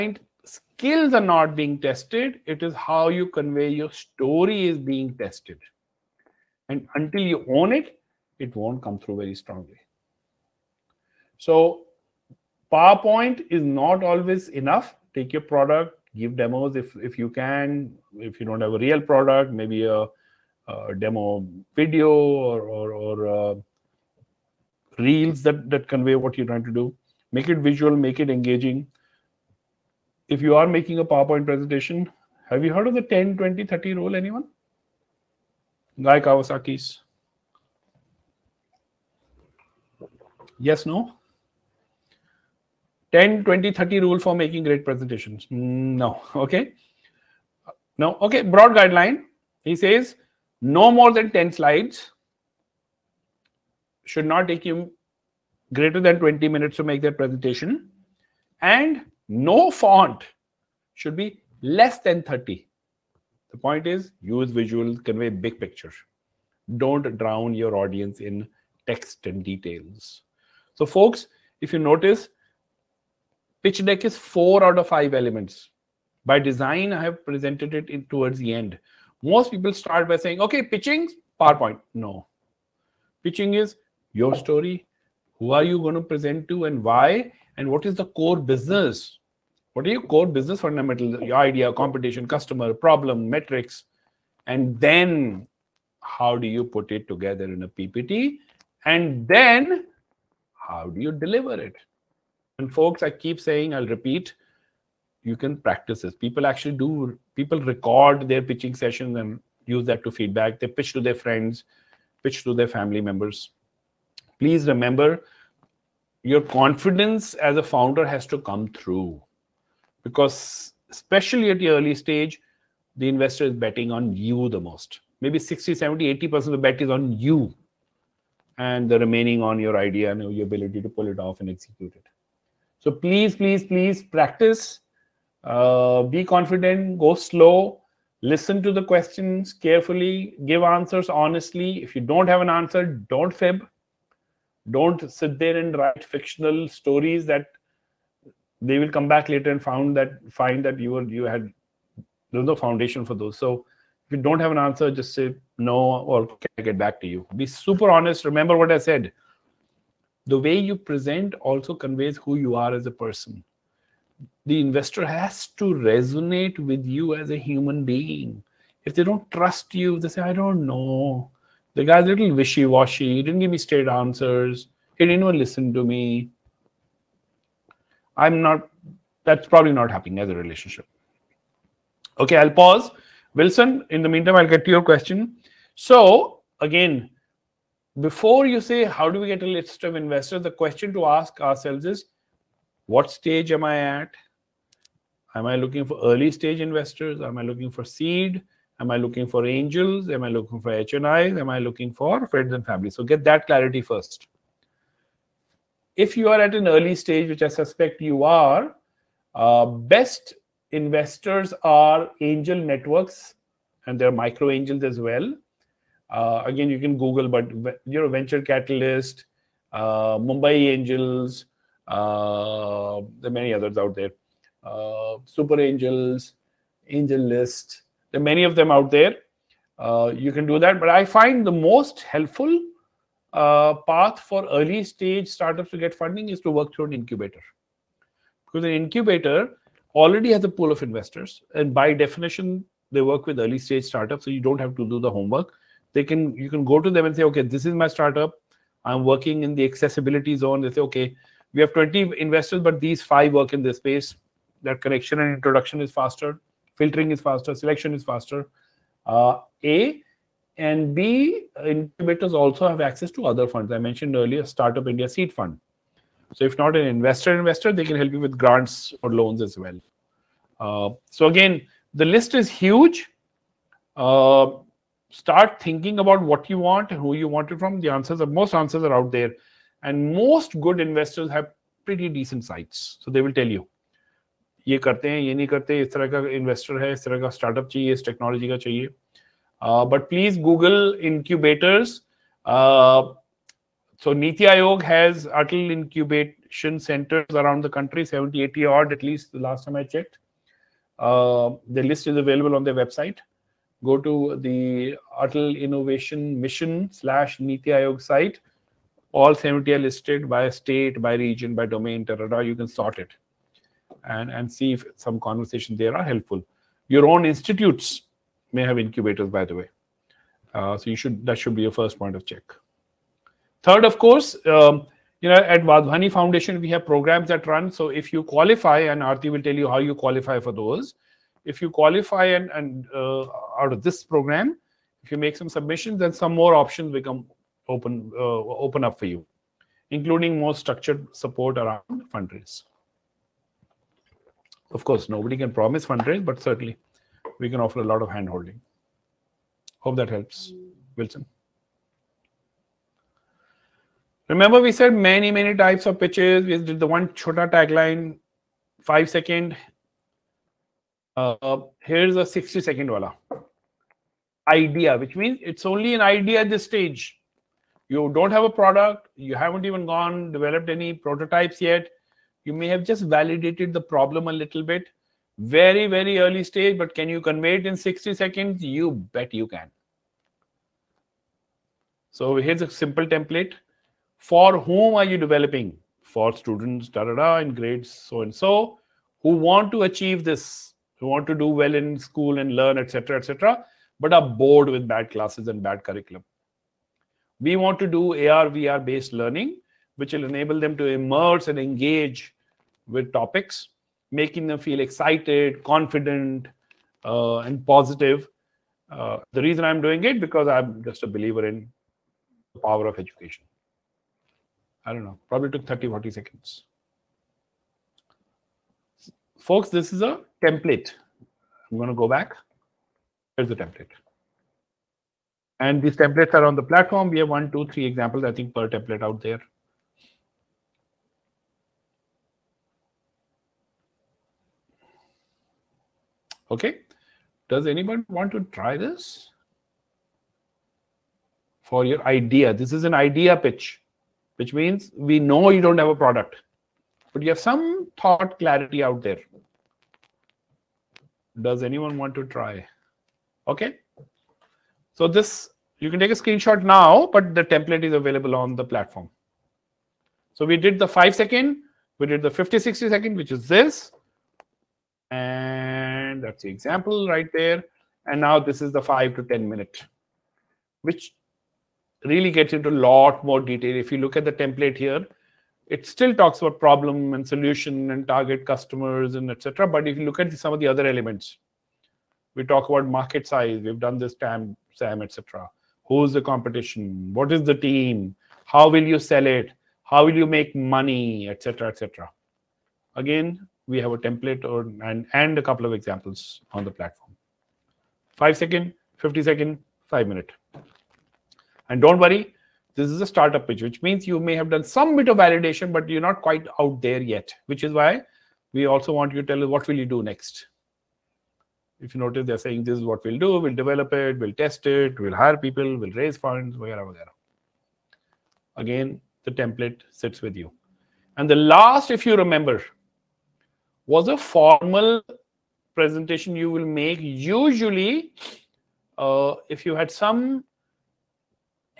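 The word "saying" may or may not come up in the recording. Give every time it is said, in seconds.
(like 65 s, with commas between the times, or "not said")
80 s, 103 s, 512 s.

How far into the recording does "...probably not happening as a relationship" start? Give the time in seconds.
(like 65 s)
179 s.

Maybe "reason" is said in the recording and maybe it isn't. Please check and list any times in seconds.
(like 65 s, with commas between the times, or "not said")
409 s.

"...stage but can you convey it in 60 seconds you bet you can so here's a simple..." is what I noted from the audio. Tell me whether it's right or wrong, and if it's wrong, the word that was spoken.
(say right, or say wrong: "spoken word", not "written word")
right.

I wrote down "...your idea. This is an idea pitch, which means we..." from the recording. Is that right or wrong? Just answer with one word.
right.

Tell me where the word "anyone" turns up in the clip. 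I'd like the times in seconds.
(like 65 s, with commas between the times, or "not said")
34 s, 437 s, 451 s.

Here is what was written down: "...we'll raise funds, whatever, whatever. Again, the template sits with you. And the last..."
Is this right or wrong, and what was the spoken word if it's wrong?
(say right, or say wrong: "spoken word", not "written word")
right.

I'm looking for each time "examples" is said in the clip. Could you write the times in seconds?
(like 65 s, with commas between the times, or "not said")
427 s, 466 s, 495 s.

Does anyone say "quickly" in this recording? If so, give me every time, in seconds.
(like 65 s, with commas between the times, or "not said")
not said.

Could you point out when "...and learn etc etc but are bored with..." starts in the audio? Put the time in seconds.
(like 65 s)
392 s.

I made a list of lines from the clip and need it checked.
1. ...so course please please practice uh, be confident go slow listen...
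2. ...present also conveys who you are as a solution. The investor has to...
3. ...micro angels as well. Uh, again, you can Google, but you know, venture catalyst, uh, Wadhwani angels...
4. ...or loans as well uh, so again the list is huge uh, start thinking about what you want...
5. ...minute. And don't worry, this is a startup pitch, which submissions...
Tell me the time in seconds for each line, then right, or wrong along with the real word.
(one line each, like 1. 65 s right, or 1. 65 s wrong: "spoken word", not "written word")
1. 132 s wrong: "please", not "course"
2. 160 s wrong: "person", not "solution"
3. 214 s wrong: "Mumbai", not "Wadhwani"
4. 269 s right
5. 500 s wrong: "means", not "submissions".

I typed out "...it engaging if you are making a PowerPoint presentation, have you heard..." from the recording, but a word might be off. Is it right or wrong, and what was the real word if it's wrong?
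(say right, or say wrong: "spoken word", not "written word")
right.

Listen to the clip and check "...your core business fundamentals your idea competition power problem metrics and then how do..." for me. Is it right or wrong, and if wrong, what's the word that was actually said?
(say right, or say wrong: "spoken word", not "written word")
wrong: "customer", not "power".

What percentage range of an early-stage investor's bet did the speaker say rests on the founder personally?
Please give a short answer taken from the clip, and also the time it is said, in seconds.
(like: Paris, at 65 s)
60-80%, at 125 s.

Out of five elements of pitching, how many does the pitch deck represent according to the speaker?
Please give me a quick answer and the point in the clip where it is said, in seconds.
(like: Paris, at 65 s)
4 out of 5, at 74 s.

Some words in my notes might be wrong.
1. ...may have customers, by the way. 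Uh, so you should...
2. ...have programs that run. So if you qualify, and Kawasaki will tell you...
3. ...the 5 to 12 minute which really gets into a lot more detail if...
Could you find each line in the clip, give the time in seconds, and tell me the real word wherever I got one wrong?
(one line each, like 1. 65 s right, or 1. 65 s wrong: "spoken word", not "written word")
1. 318 s wrong: "incubators", not "customers"
2. 326 s wrong: "Arti", not "Kawasaki"
3. 468 s wrong: "10", not "12".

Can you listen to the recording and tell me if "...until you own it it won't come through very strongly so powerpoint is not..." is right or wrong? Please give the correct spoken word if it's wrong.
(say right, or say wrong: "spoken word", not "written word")
right.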